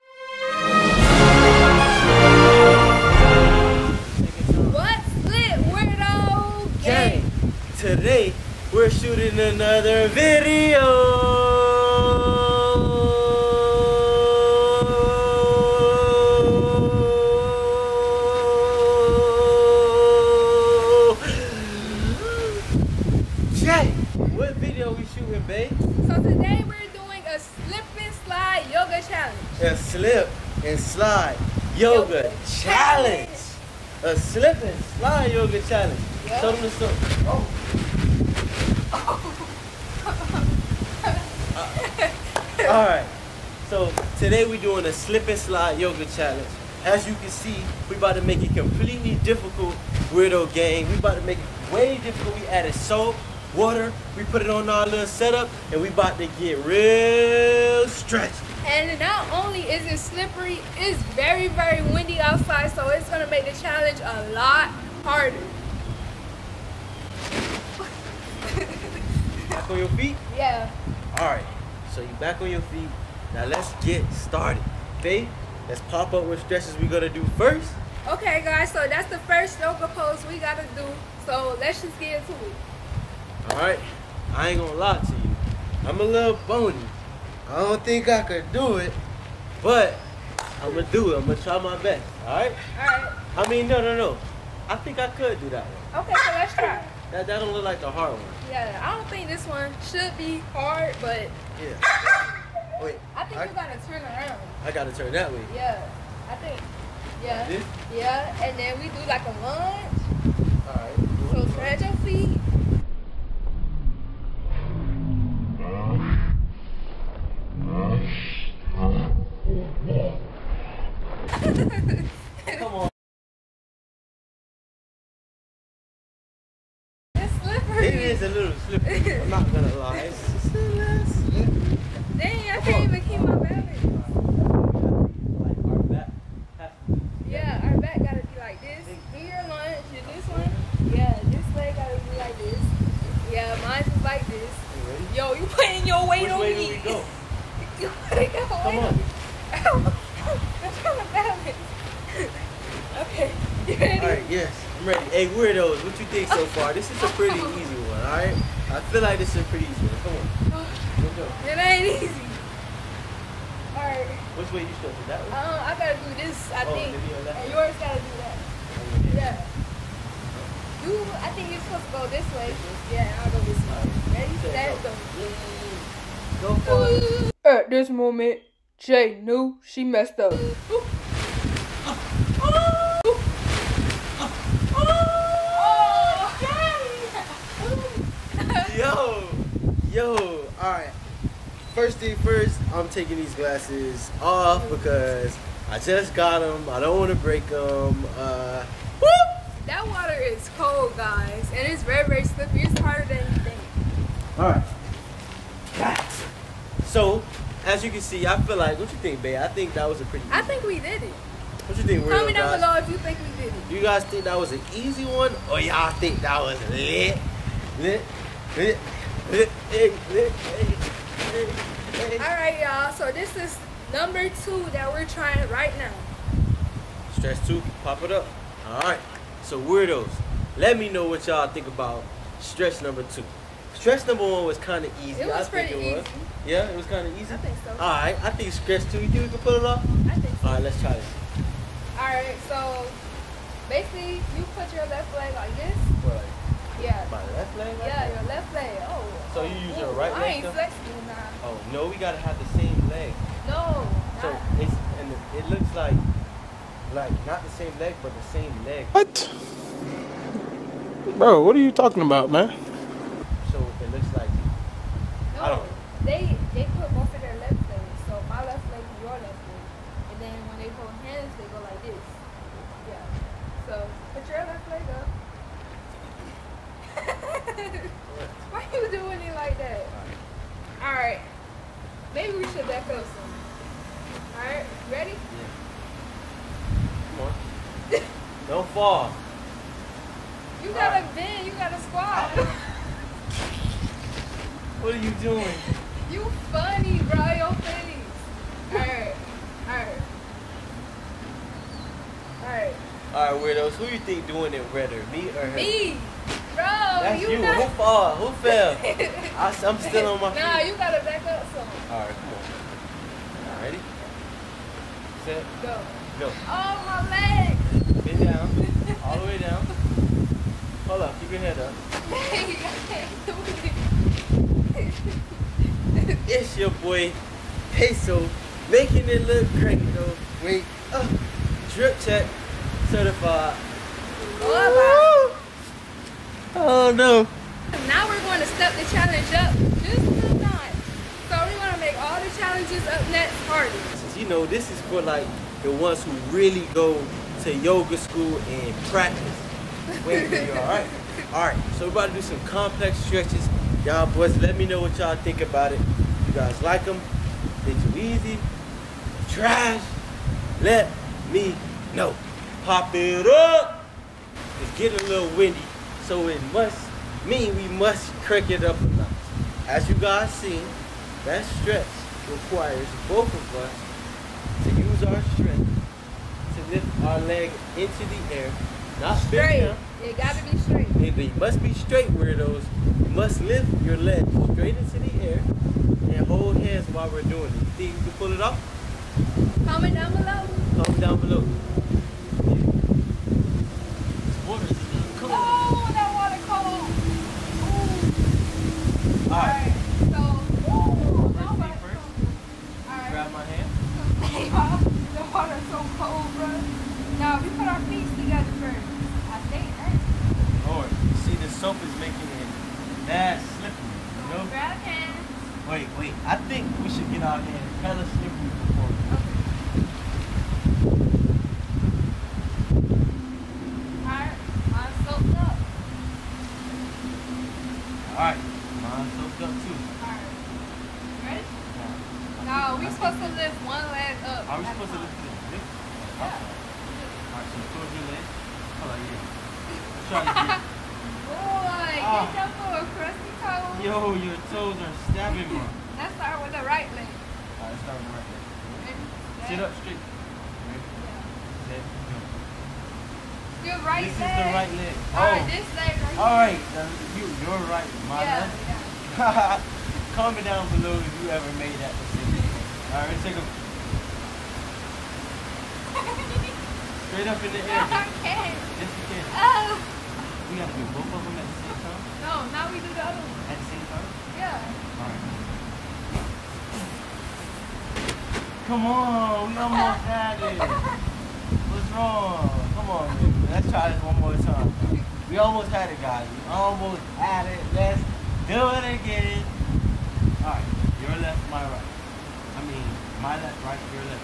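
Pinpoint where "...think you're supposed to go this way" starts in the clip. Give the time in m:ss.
2:51.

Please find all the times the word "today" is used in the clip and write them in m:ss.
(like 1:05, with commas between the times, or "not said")
0:26, 0:44.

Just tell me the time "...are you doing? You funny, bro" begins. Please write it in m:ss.
4:54.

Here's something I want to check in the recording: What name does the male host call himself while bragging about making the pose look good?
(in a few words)
Peso.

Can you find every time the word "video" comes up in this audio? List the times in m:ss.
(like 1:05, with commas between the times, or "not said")
0:10, 0:24.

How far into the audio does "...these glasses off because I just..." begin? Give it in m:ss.
3:13.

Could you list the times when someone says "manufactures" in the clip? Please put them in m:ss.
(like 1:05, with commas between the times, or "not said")
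not said.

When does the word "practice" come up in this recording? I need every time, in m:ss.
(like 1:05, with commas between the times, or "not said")
5:48.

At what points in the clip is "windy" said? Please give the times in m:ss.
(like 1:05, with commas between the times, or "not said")
1:01, 6:05.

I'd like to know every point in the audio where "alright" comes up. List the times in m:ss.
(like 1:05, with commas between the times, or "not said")
1:50, 2:38, 2:43.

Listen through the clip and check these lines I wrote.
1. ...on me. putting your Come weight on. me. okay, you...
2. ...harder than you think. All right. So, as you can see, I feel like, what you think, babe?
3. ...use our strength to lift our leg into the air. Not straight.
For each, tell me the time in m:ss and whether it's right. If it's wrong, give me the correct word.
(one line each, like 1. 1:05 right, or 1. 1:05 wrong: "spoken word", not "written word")
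1. 2:26 right
2. 3:22 right
3. 6:14 right.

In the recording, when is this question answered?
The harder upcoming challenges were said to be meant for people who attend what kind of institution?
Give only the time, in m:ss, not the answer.
5:47.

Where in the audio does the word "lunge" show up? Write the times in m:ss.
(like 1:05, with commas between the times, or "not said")
1:49, 2:19.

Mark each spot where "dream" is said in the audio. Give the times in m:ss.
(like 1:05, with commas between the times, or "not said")
not said.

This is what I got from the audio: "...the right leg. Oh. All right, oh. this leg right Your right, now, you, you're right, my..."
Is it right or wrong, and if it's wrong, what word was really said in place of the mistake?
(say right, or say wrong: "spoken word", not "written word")
wrong: "All", not "Your".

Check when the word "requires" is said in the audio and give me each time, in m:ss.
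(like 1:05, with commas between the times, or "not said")
6:12.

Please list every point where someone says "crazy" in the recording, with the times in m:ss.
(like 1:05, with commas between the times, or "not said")
5:29.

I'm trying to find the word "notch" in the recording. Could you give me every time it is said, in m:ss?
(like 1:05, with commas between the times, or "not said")
5:40, 6:08.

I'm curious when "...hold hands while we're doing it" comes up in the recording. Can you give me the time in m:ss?
6:26.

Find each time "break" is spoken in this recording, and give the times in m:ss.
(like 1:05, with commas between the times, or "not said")
3:17.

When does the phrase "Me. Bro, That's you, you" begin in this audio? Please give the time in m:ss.
5:05.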